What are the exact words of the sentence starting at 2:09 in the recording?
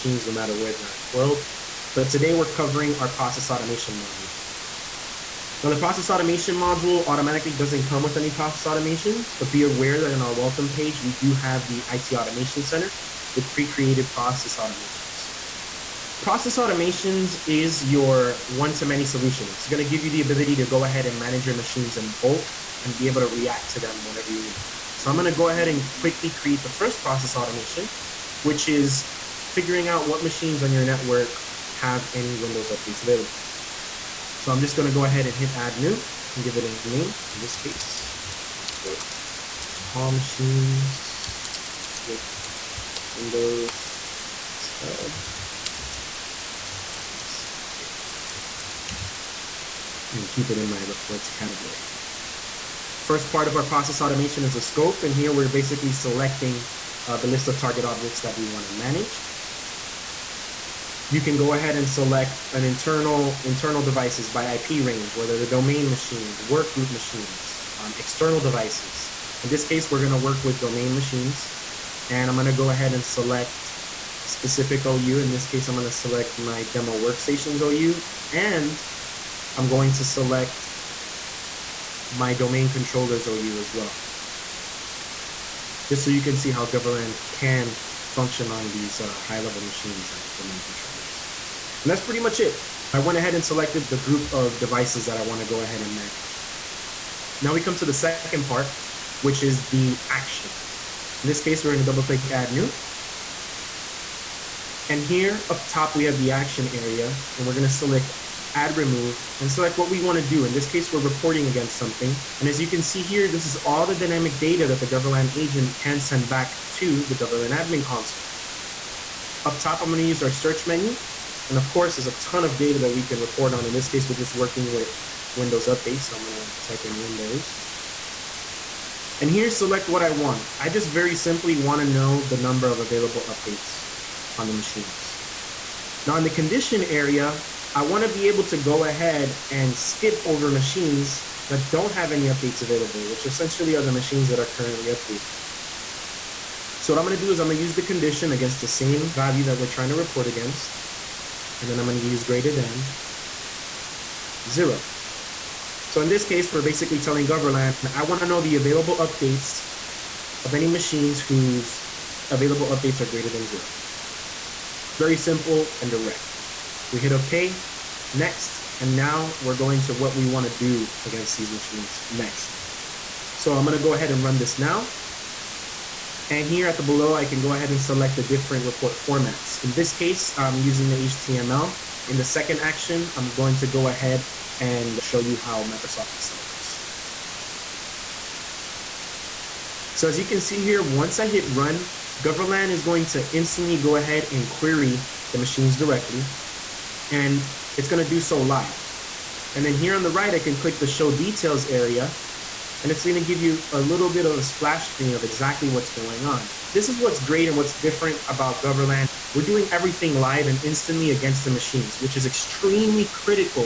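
And here, select what I want.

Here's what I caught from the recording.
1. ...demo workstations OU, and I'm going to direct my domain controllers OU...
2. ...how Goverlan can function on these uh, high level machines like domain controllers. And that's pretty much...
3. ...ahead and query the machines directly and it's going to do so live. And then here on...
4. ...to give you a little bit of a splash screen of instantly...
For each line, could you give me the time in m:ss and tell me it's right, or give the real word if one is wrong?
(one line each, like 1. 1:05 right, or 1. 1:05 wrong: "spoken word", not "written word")
1. 1:16 wrong: "select", not "direct"
2. 1:26 right
3. 3:13 right
4. 3:23 wrong: "exactly", not "instantly".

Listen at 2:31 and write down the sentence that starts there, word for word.
And then I'm going to use greater than 0.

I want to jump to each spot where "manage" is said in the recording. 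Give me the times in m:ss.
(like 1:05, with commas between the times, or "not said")
0:21, 0:58, 1:35.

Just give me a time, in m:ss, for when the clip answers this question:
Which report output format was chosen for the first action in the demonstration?
3:00.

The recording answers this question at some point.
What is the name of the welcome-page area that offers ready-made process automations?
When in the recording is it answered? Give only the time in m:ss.
0:11.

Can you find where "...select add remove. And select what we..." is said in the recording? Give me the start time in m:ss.
1:47.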